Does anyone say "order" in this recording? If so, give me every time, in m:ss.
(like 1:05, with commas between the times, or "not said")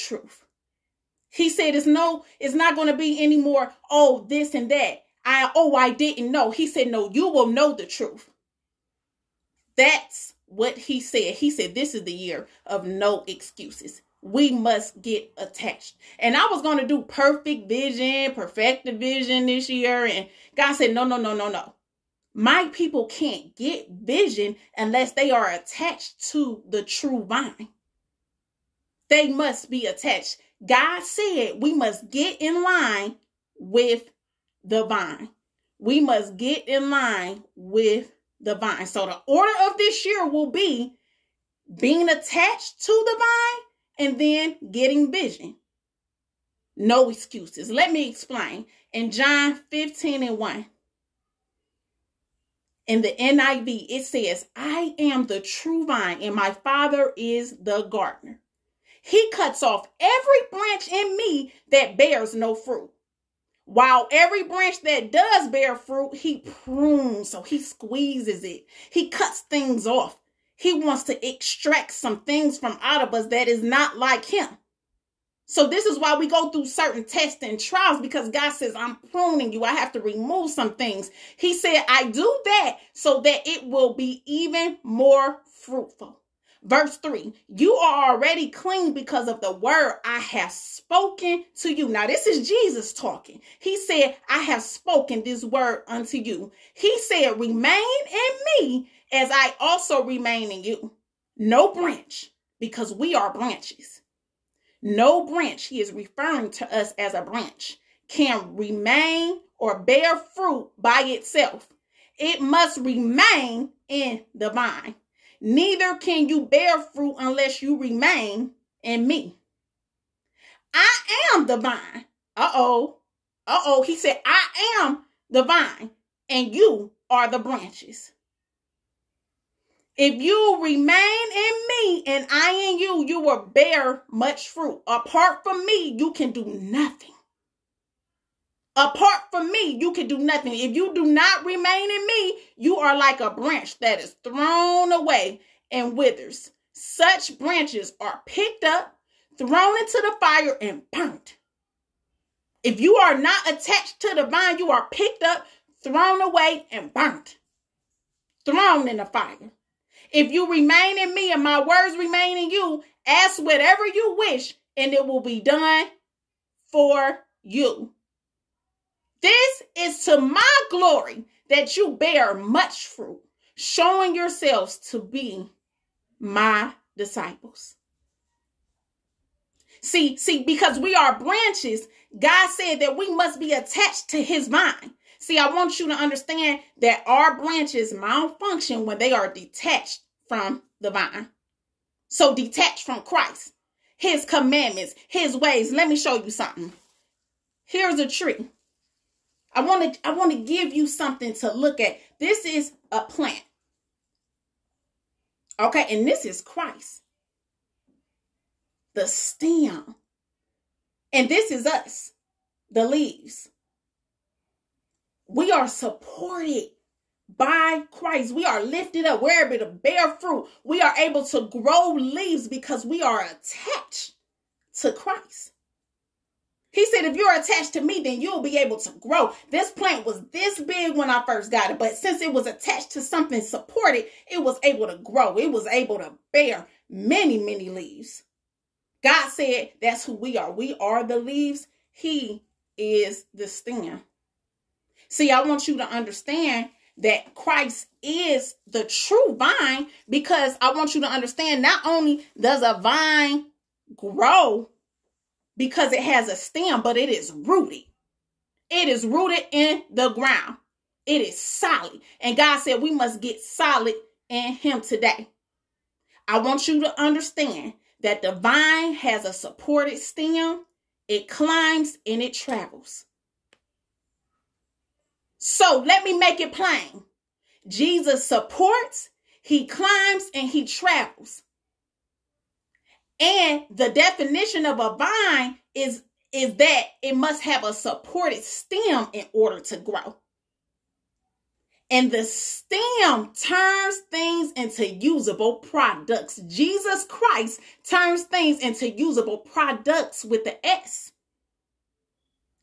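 0:39, 4:49.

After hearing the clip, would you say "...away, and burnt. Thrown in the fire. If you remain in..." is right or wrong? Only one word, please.
right.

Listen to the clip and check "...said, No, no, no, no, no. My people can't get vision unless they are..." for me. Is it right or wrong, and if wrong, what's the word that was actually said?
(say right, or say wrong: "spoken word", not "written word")
right.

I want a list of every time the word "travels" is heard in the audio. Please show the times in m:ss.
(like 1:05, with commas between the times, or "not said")
4:32, 4:40.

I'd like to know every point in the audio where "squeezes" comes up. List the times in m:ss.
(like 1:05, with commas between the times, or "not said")
1:07.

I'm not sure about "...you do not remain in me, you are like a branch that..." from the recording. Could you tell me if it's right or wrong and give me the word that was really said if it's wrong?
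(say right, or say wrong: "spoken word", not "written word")
right.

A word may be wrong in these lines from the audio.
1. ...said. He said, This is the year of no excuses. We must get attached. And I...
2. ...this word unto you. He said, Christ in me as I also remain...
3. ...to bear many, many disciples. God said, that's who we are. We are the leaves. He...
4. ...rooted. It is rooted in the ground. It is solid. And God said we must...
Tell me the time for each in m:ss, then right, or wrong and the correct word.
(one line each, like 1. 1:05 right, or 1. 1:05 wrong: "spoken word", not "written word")
1. 0:10 right
2. 1:35 wrong: "Remain", not "Christ"
3. 3:55 wrong: "leaves", not "disciples"
4. 4:17 right.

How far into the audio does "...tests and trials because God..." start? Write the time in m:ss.
1:17.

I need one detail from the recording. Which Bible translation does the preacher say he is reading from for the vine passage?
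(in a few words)
NIV.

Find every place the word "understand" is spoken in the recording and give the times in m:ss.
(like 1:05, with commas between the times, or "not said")
3:05, 4:05, 4:11, 4:27.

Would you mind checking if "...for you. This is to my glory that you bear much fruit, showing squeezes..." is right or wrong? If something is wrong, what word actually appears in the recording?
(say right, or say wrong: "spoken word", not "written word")
wrong: "yourselves", not "squeezes".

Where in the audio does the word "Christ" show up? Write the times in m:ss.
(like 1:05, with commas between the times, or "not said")
3:13, 3:26, 3:37, 3:44, 4:07, 4:57.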